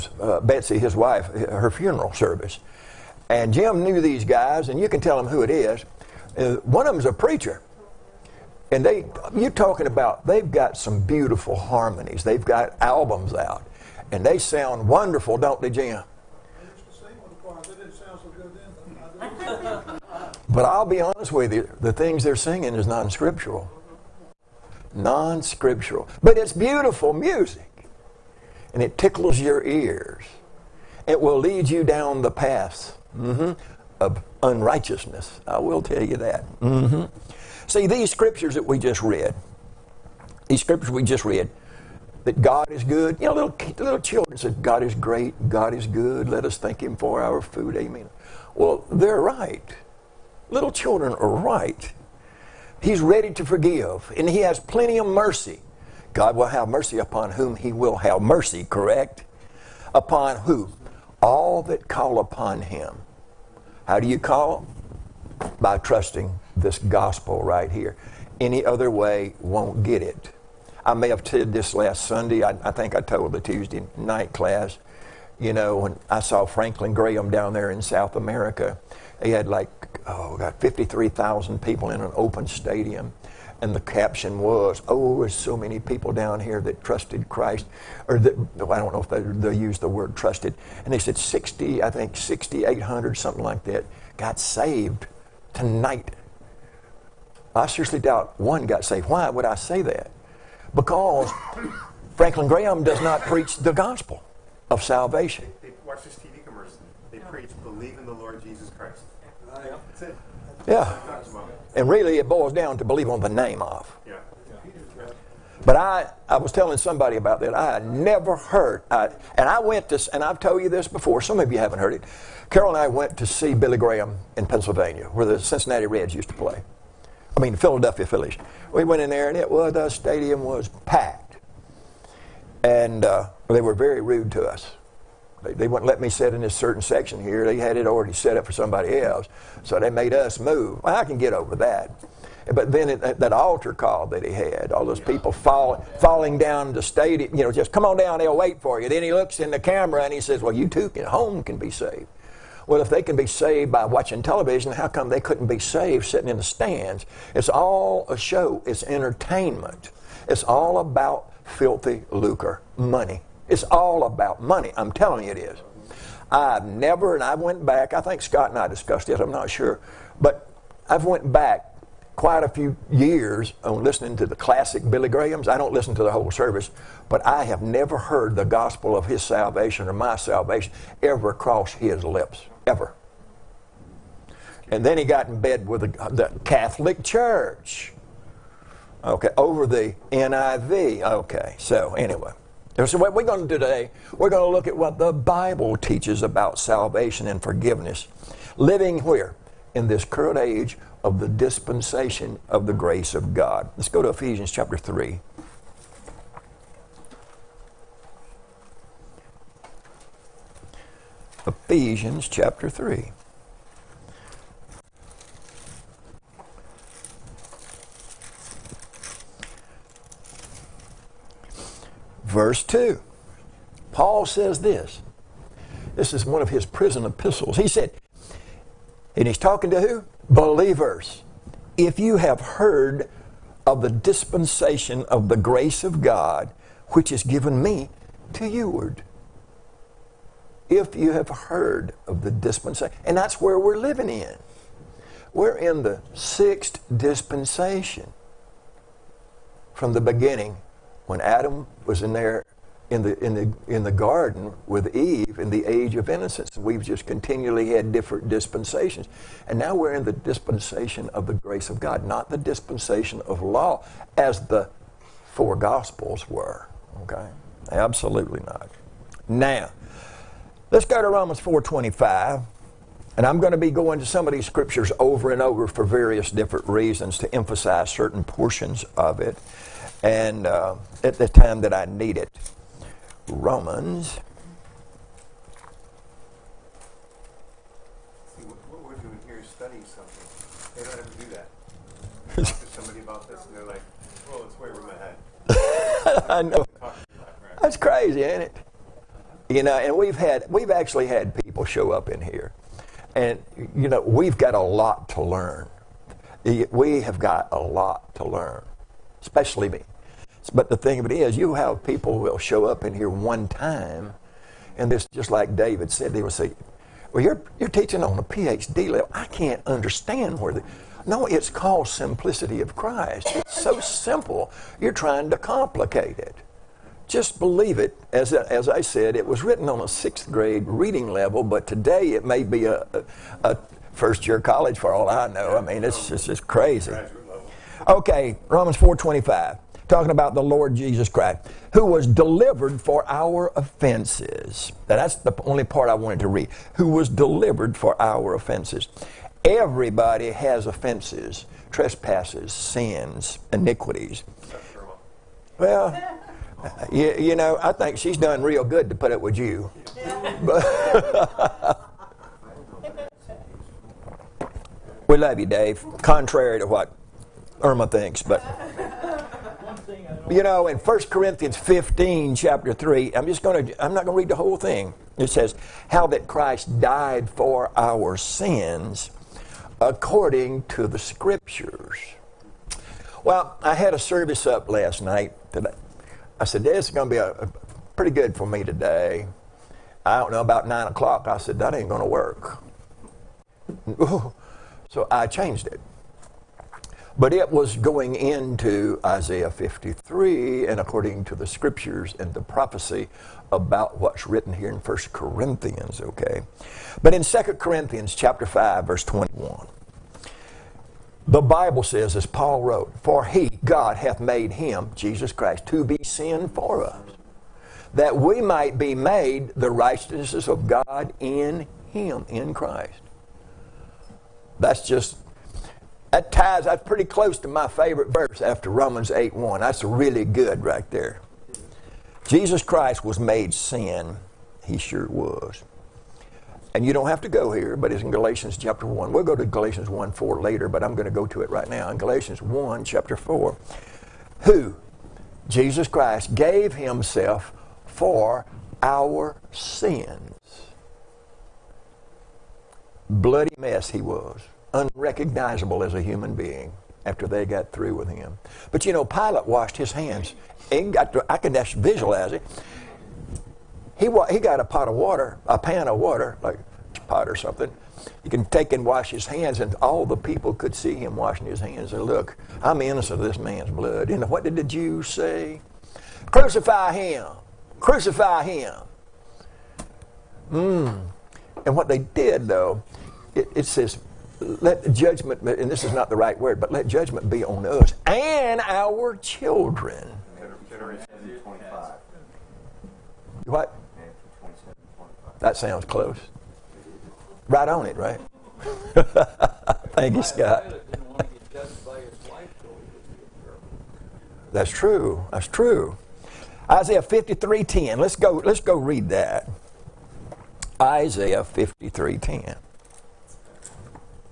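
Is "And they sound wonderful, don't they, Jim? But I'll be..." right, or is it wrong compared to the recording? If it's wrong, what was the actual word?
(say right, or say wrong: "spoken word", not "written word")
right.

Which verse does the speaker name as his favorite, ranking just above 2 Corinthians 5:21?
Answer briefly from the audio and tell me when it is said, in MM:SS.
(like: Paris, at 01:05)
Romans 8:1, at 07:08.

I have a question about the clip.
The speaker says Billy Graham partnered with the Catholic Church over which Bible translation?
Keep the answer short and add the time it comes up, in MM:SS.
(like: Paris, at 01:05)
NIV, at 03:10.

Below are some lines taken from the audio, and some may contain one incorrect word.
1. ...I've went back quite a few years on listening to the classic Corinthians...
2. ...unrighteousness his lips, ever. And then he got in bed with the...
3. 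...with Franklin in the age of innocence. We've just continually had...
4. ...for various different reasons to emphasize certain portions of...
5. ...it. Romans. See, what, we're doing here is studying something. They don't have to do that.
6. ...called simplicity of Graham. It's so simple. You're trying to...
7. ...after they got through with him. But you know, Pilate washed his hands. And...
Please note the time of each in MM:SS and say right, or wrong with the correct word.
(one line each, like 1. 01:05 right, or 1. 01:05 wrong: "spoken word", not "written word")
1. 02:50 wrong: "Billy", not "Corinthians"
2. 03:01 wrong: "cross", not "unrighteousness"
3. 04:14 wrong: "Eve", not "Franklin"
4. 04:35 right
5. 04:42 right
6. 05:21 wrong: "Christ", not "Graham"
7. 07:37 right.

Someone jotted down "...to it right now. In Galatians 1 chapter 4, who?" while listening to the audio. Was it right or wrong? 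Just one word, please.
right.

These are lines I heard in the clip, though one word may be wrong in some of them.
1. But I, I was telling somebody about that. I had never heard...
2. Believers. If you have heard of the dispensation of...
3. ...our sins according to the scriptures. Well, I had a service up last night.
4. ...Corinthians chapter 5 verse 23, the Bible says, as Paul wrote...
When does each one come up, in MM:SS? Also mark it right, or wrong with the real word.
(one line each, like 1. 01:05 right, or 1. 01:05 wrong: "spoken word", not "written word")
1. 01:55 right
2. 03:50 right
3. 06:17 right
4. 06:47 wrong: "21", not "23".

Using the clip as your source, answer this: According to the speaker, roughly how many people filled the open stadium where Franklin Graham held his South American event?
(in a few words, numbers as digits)
53,000.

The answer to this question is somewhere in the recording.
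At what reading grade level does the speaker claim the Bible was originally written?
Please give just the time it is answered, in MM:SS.
05:29.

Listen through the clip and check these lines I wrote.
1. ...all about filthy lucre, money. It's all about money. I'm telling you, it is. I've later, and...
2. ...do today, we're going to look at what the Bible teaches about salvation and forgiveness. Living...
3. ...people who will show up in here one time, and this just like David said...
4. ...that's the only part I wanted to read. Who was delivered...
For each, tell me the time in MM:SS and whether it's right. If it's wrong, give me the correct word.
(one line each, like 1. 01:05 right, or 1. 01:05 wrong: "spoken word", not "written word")
1. 02:40 wrong: "never", not "later"
2. 03:13 right
3. 05:11 right
4. 05:44 right.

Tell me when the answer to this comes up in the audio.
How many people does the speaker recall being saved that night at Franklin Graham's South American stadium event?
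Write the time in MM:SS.
01:32.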